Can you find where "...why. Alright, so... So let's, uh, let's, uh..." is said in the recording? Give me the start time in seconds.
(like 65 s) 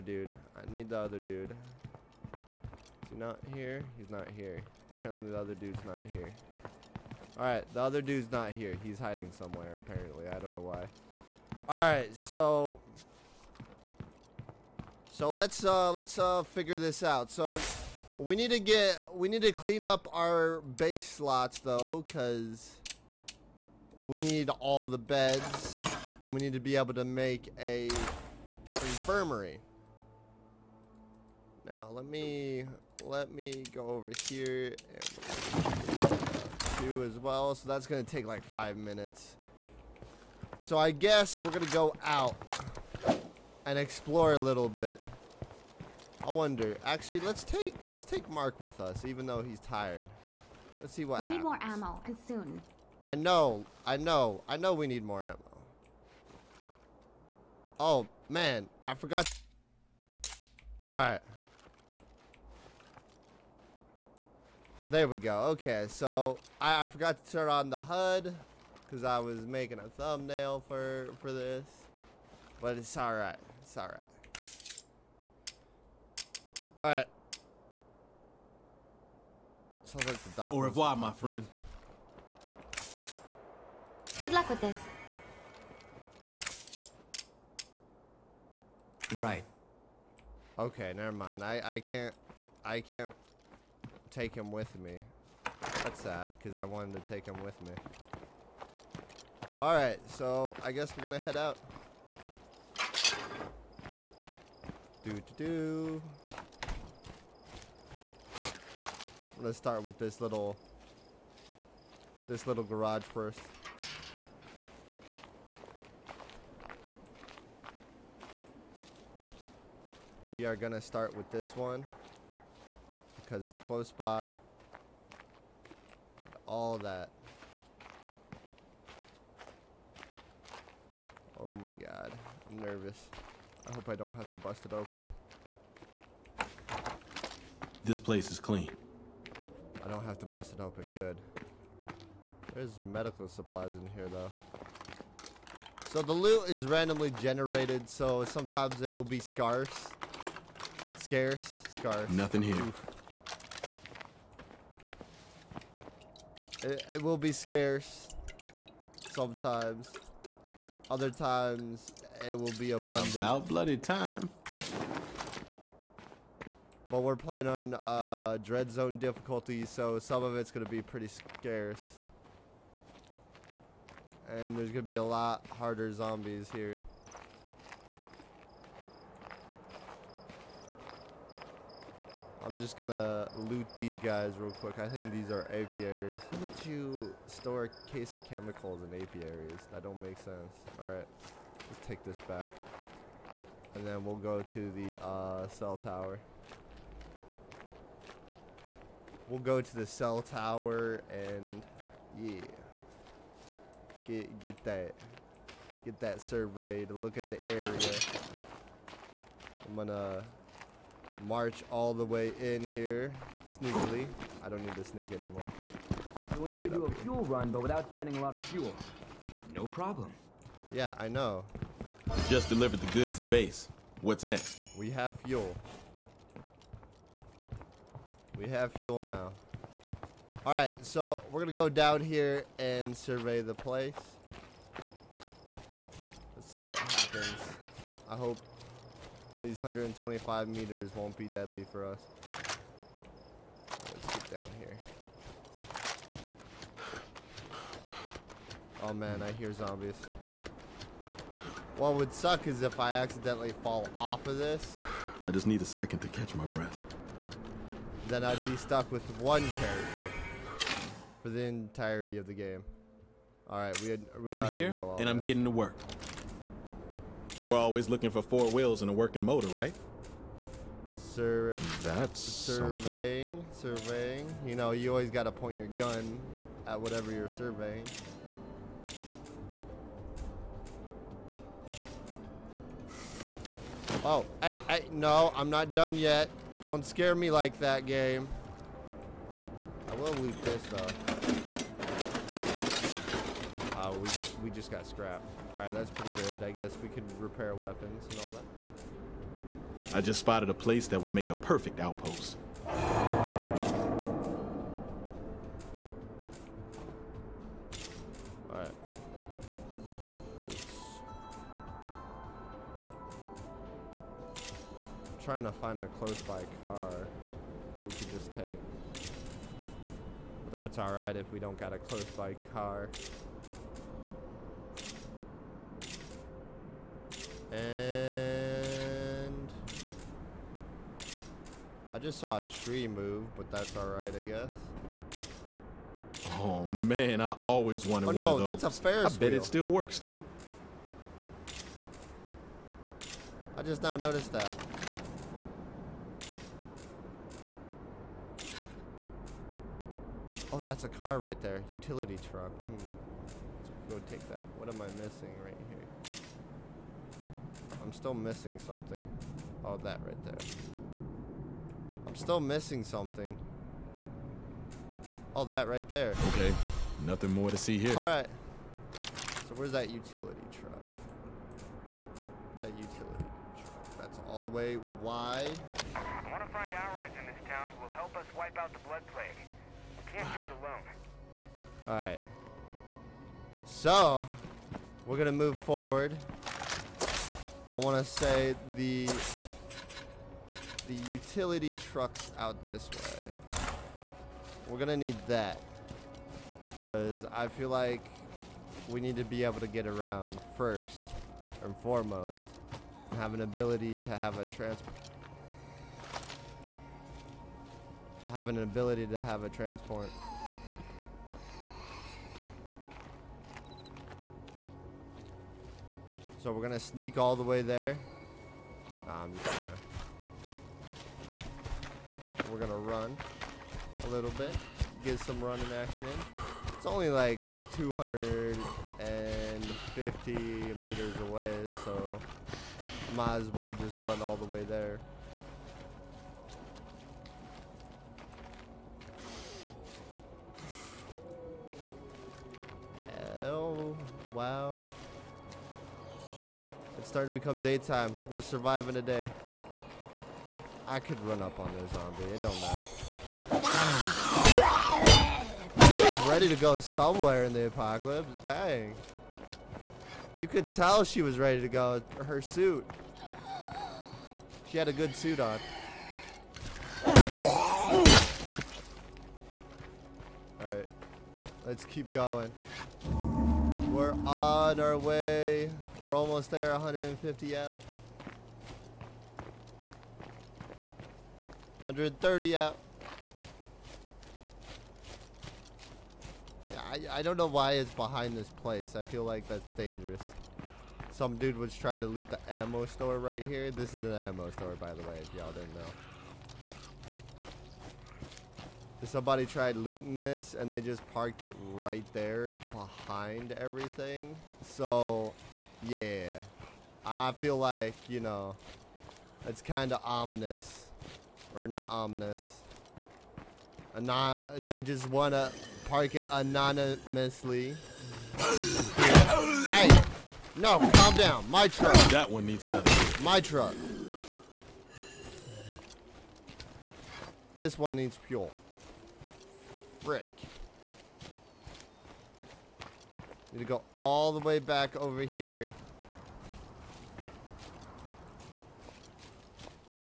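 10 s.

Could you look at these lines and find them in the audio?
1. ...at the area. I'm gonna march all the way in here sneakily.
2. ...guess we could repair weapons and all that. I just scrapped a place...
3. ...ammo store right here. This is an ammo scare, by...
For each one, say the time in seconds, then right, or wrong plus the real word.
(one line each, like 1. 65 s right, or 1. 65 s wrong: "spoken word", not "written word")
1. 207 s right
2. 296 s wrong: "spotted", not "scrapped"
3. 492 s wrong: "store", not "scare".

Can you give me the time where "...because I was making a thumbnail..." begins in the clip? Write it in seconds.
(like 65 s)
68 s.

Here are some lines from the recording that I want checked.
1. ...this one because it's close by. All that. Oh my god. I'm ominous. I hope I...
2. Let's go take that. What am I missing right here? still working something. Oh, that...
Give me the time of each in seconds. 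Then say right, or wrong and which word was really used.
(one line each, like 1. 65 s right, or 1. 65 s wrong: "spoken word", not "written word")
1. 121 s wrong: "nervous", not "ominous"
2. 353 s wrong: "missing", not "working".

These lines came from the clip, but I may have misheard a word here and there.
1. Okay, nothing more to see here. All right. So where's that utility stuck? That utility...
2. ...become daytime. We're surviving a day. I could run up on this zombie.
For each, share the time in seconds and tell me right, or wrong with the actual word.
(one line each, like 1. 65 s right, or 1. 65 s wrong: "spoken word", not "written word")
1. 366 s wrong: "truck", not "stuck"
2. 447 s right.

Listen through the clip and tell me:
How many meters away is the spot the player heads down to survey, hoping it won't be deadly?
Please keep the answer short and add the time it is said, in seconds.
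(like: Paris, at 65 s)
125 meters, at 239 s.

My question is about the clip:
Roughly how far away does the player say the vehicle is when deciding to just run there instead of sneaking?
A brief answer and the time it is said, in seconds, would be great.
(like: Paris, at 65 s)
250 meters, at 427 s.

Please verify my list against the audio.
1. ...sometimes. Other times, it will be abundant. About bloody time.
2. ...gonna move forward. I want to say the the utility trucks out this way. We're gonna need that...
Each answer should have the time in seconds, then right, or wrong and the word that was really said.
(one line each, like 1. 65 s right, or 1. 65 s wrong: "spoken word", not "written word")
1. 159 s right
2. 385 s right.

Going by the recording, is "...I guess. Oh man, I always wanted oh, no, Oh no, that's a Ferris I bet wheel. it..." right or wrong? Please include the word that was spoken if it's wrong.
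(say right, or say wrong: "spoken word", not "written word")
right.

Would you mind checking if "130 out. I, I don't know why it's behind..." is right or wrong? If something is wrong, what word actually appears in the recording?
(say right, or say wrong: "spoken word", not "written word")
right.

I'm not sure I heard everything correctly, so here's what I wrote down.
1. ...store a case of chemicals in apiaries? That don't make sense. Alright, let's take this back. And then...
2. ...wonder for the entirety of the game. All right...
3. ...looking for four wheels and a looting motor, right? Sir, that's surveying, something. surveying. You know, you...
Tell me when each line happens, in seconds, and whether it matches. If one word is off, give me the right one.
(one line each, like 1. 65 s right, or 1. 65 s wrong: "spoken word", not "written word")
1. 187 s right
2. 259 s wrong: "character", not "wonder"
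3. 267 s wrong: "working", not "looting".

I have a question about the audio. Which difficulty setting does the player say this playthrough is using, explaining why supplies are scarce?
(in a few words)
Dread Zone.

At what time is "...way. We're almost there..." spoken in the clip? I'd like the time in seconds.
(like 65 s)
474 s.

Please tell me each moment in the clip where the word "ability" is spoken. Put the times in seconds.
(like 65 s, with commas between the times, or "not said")
403 s, 408 s.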